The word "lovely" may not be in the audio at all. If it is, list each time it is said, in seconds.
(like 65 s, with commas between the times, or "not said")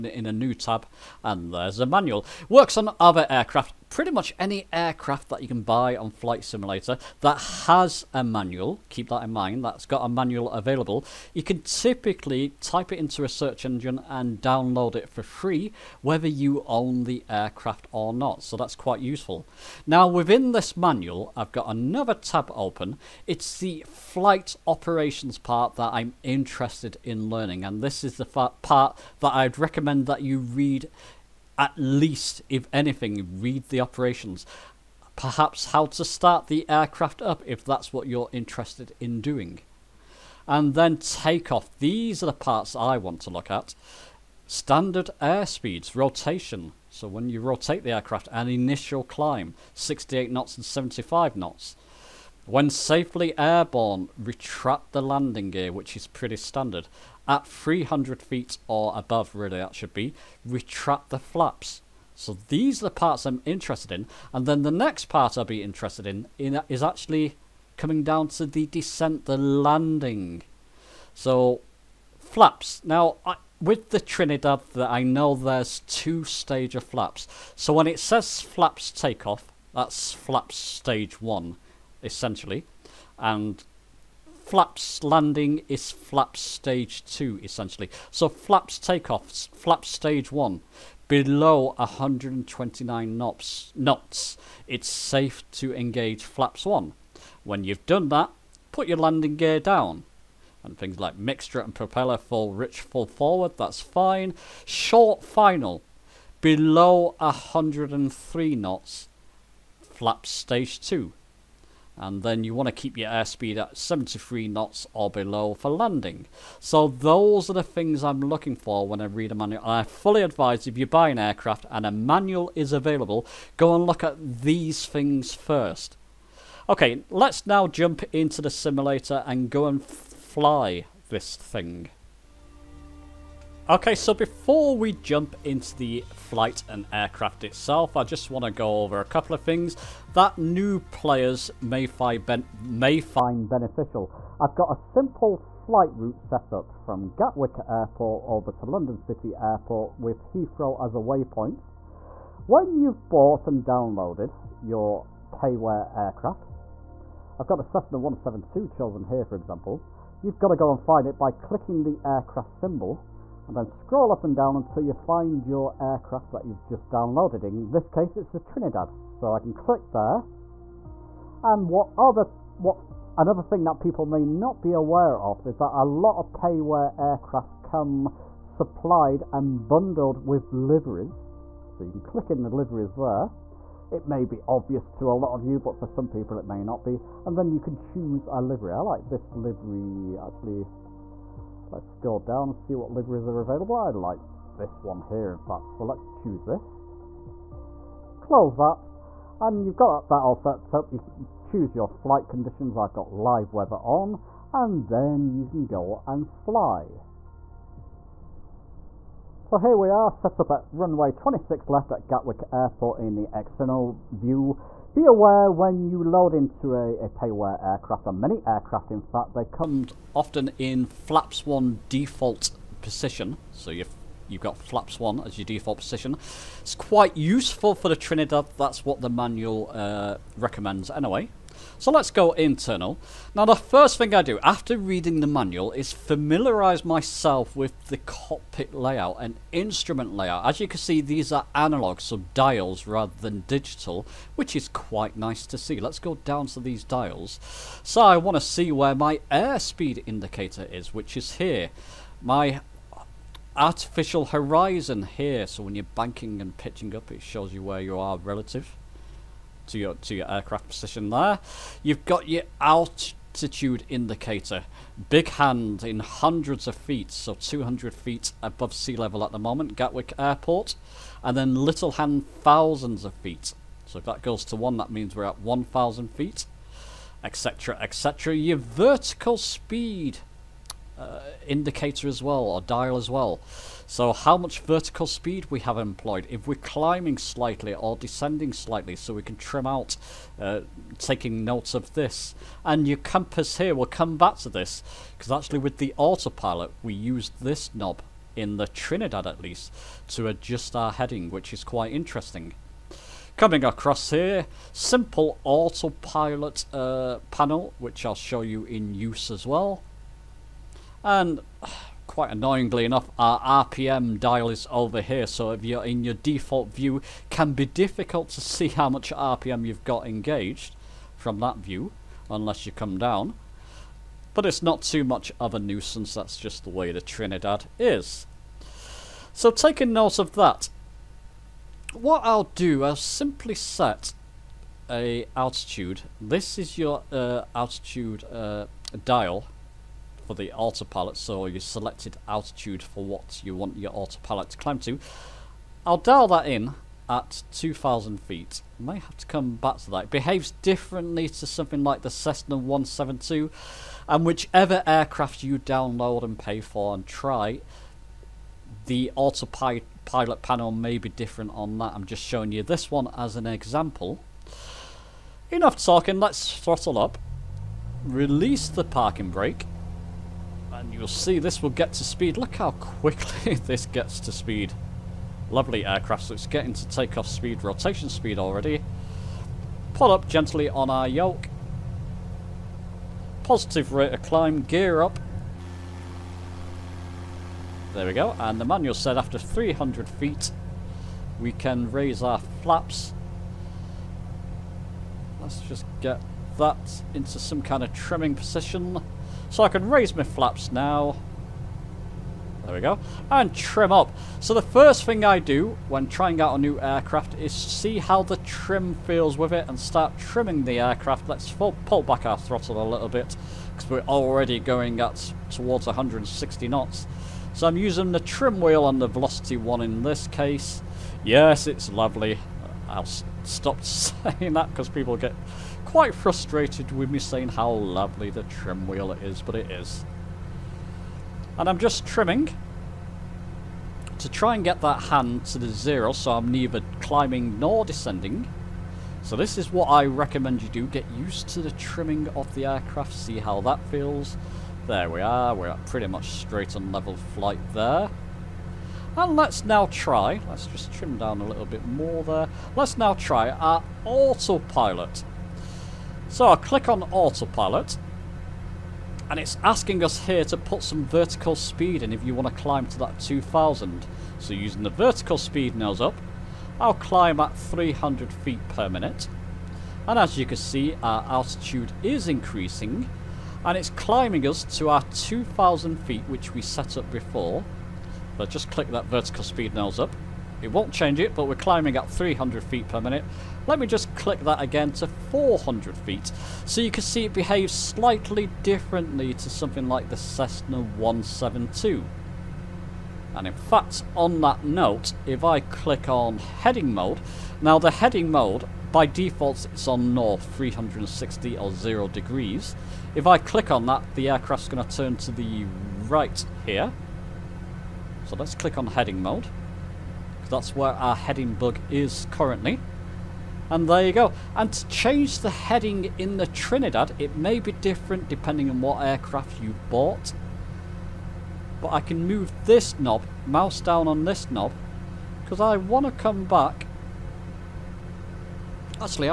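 375 s, 421 s, 427 s.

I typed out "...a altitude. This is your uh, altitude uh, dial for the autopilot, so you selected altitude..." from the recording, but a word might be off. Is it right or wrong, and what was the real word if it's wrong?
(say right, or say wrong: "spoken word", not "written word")
right.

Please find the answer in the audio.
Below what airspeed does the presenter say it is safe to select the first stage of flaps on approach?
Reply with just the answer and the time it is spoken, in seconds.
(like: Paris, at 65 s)
129 knots, at 91 s.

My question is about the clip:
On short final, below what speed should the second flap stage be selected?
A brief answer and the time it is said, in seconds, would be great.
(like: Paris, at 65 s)
103 knots, at 107 s.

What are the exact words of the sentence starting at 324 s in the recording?
But it's not too much of a nuisance, that's just the way the Trinidad is.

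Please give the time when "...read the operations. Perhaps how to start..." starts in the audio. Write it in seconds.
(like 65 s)
33 s.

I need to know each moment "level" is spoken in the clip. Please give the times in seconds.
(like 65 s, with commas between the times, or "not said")
268 s, 446 s.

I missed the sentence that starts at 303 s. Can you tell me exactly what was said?
Coming across here, simple autopilot uh, panel, which I'll show you in use as well.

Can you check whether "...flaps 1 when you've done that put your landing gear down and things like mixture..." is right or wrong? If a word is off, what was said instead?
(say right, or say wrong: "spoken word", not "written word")
right.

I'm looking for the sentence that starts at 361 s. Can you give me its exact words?
I'm just showing you this one as an example.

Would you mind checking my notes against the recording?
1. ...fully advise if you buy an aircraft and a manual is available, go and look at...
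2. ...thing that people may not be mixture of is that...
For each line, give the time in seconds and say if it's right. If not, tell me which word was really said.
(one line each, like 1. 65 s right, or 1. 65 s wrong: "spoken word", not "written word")
1. 119 s right
2. 173 s wrong: "aware", not "mixture".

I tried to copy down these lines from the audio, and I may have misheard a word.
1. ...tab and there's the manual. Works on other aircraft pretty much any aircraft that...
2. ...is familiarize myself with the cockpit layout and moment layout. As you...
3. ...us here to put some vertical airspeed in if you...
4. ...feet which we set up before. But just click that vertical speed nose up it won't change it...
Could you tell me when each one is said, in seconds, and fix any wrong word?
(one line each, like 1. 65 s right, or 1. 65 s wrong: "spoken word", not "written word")
1. 0 s right
2. 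235 s wrong: "instrument", not "moment"
3. 460 s wrong: "speed", not "airspeed"
4. 475 s right.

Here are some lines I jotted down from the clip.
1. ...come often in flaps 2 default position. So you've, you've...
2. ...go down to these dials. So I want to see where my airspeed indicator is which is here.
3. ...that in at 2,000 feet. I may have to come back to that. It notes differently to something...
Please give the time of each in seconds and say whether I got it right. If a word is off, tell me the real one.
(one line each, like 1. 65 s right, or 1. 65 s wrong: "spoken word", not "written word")
1. 219 s wrong: "1", not "2"
2. 245 s right
3. 346 s wrong: "behaves", not "notes".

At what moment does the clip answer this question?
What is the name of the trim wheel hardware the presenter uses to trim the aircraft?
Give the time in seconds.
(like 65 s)
419 s.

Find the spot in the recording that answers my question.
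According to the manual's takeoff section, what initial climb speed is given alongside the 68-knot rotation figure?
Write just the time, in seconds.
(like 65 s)
50 s.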